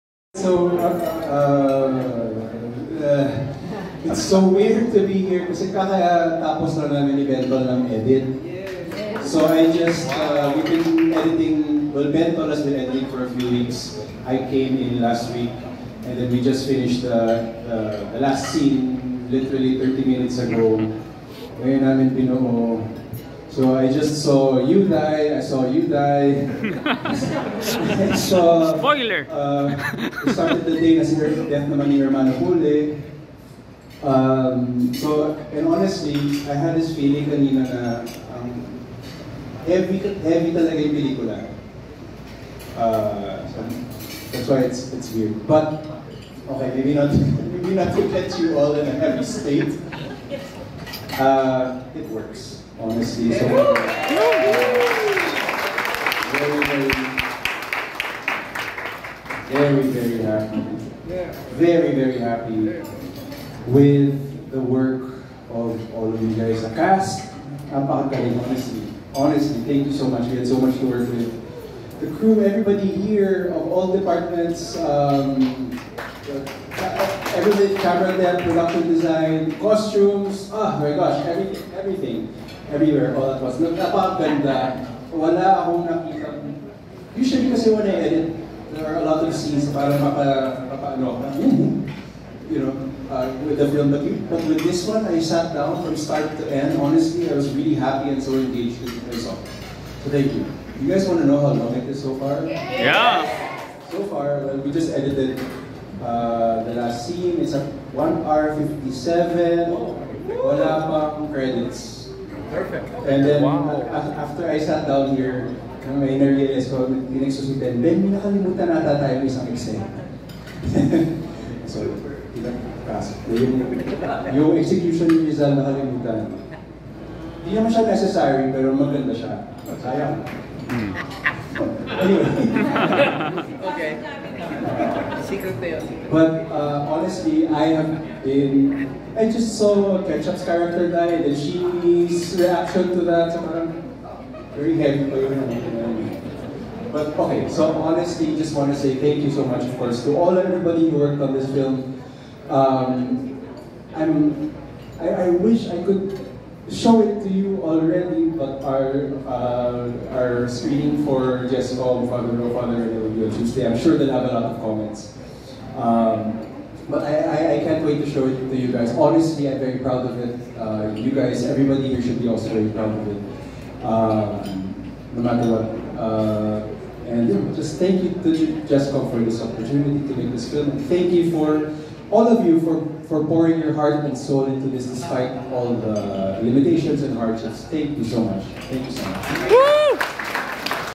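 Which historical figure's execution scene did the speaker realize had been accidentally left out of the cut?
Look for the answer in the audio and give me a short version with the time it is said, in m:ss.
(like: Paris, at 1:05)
Rizal, at 2:05.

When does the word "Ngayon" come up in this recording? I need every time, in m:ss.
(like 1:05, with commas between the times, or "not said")
0:21.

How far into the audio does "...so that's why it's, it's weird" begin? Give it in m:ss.
0:43.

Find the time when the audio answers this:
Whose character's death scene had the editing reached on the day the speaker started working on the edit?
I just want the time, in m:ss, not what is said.
0:31.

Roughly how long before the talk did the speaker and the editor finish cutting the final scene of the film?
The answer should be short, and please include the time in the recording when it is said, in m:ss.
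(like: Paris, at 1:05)
30 minutes, at 0:19.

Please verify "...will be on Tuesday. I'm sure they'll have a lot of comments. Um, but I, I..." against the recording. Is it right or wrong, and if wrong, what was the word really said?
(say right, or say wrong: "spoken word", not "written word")
right.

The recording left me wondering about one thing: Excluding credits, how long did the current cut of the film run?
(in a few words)
1 hour 57.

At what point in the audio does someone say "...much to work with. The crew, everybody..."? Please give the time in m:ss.
1:10.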